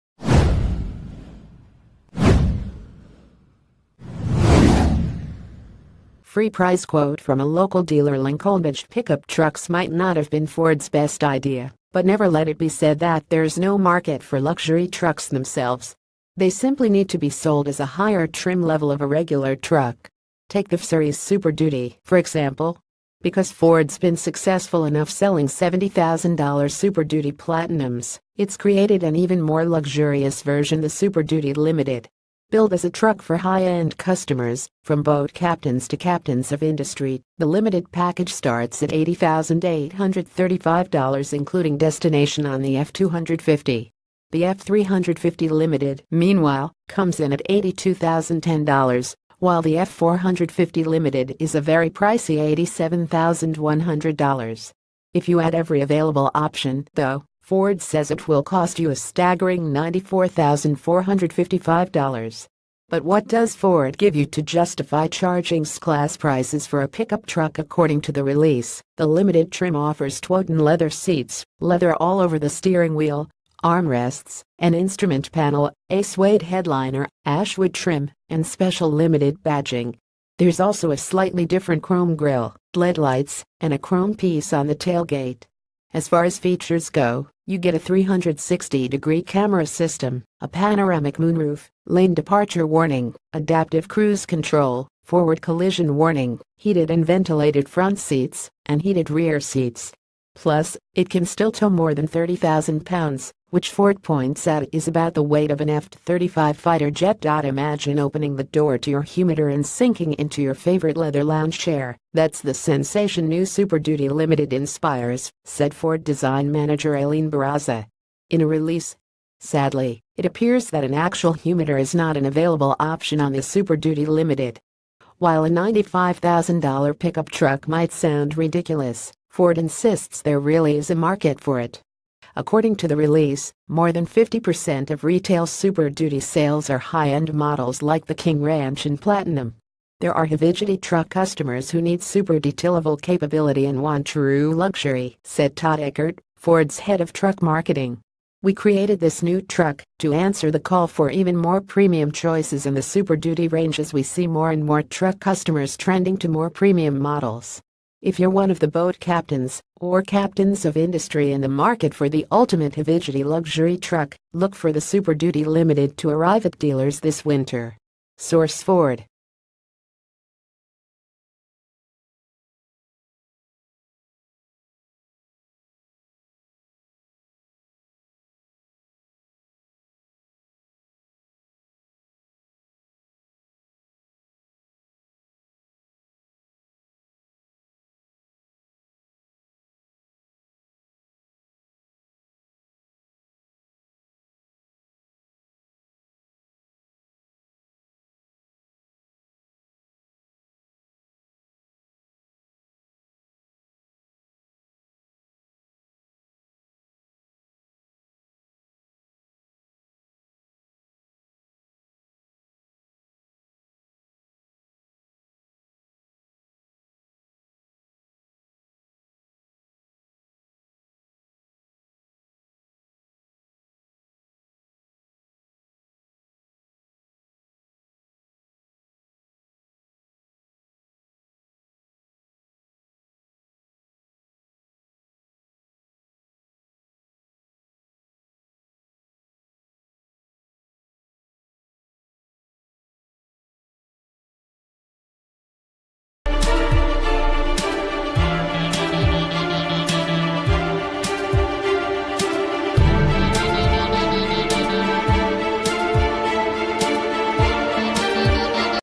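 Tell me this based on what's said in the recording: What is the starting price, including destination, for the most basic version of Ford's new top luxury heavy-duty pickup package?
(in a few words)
$80,835.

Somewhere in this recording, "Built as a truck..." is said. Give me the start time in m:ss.
0:32.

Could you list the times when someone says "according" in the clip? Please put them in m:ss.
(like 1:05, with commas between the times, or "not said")
1:07, 2:12.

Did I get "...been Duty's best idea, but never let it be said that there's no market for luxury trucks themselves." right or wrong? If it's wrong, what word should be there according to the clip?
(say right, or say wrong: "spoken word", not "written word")
wrong: "Ford", not "Duty".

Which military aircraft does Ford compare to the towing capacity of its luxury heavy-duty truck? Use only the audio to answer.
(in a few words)
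F-35 fighter jet.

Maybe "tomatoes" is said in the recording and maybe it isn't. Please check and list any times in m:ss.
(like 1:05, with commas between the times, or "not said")
not said.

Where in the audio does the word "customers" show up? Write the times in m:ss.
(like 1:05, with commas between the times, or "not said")
0:33, 2:21, 2:35.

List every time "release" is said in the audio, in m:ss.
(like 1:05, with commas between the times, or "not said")
1:08, 1:58, 2:12.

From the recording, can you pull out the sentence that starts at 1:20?
There's also a slightly different chrome grille, LED lights, and a chrome piece on the tailgate.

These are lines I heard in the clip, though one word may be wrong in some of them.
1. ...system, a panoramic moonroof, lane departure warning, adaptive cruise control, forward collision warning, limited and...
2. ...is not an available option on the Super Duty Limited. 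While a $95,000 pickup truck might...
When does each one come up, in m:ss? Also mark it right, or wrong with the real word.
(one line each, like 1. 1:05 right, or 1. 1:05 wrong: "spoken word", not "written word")
1. 1:29 wrong: "heated", not "limited"
2. 2:01 right.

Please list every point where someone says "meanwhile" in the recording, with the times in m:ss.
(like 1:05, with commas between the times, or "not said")
0:46.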